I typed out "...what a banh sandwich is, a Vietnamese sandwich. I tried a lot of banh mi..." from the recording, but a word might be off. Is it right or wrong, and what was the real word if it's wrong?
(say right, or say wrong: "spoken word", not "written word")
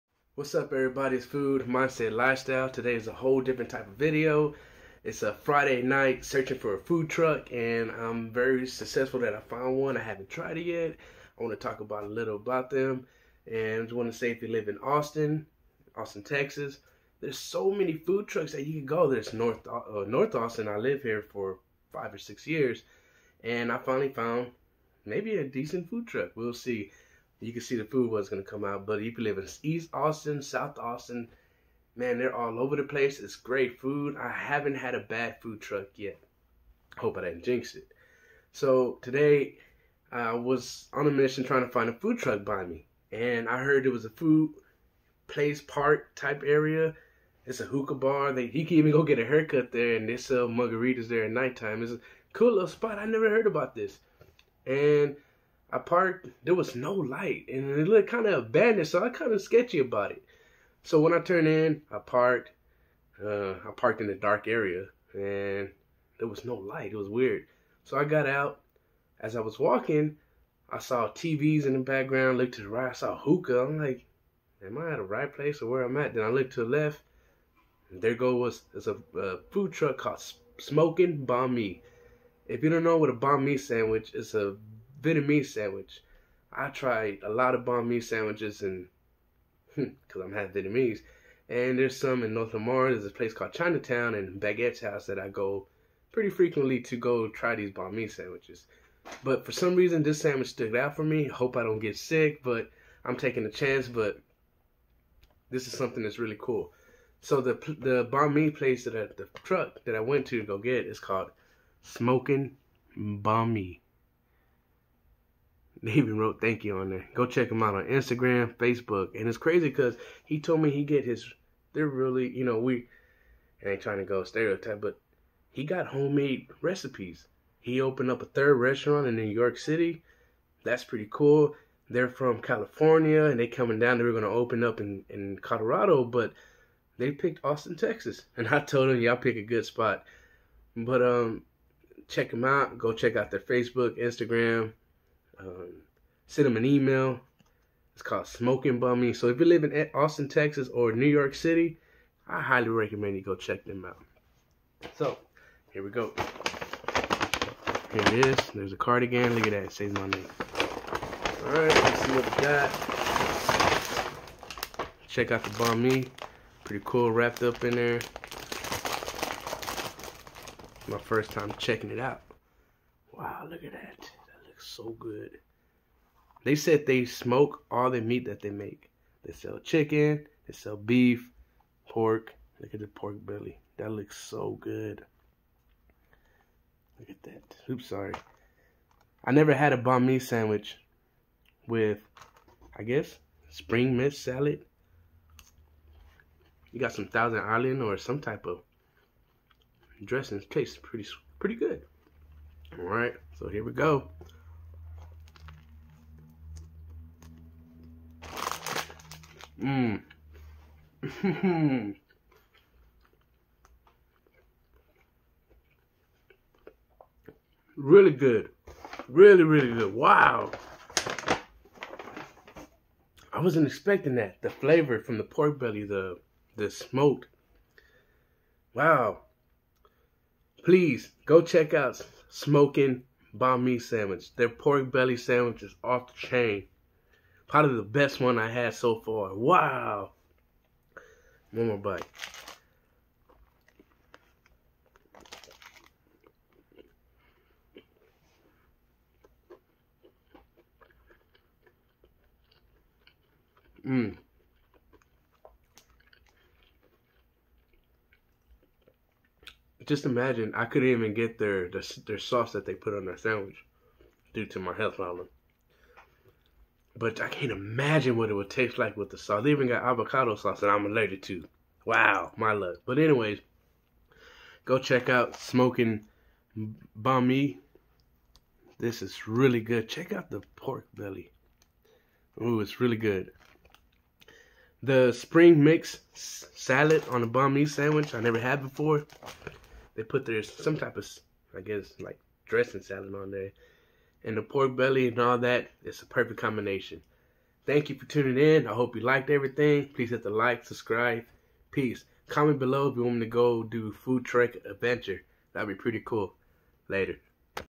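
right.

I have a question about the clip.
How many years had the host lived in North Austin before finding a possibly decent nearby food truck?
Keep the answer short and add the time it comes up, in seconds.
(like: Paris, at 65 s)
5 or 6, at 21 s.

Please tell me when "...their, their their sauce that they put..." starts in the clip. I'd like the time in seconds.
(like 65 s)
261 s.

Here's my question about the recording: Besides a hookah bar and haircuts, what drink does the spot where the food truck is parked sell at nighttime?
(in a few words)
Margaritas.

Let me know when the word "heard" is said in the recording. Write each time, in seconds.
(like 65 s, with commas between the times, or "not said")
43 s, 53 s.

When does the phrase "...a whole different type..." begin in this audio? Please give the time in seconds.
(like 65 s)
3 s.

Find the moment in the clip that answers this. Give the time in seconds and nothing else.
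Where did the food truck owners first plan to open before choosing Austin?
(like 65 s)
135 s.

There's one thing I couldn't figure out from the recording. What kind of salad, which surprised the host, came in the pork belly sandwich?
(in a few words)
Spring mix salad.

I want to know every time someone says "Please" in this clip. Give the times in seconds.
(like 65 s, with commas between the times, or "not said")
230 s, 299 s.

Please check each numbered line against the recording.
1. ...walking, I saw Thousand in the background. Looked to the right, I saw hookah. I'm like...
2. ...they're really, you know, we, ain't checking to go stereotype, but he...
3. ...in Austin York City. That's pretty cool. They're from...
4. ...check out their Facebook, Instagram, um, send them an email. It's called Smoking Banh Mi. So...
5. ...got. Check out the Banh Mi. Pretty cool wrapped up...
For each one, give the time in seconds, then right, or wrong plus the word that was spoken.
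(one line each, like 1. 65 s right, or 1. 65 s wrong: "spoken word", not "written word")
1. 69 s wrong: "TVs", not "Thousand"
2. 121 s wrong: "trying", not "checking"
3. 129 s wrong: "New", not "Austin"
4. 142 s right
5. 162 s right.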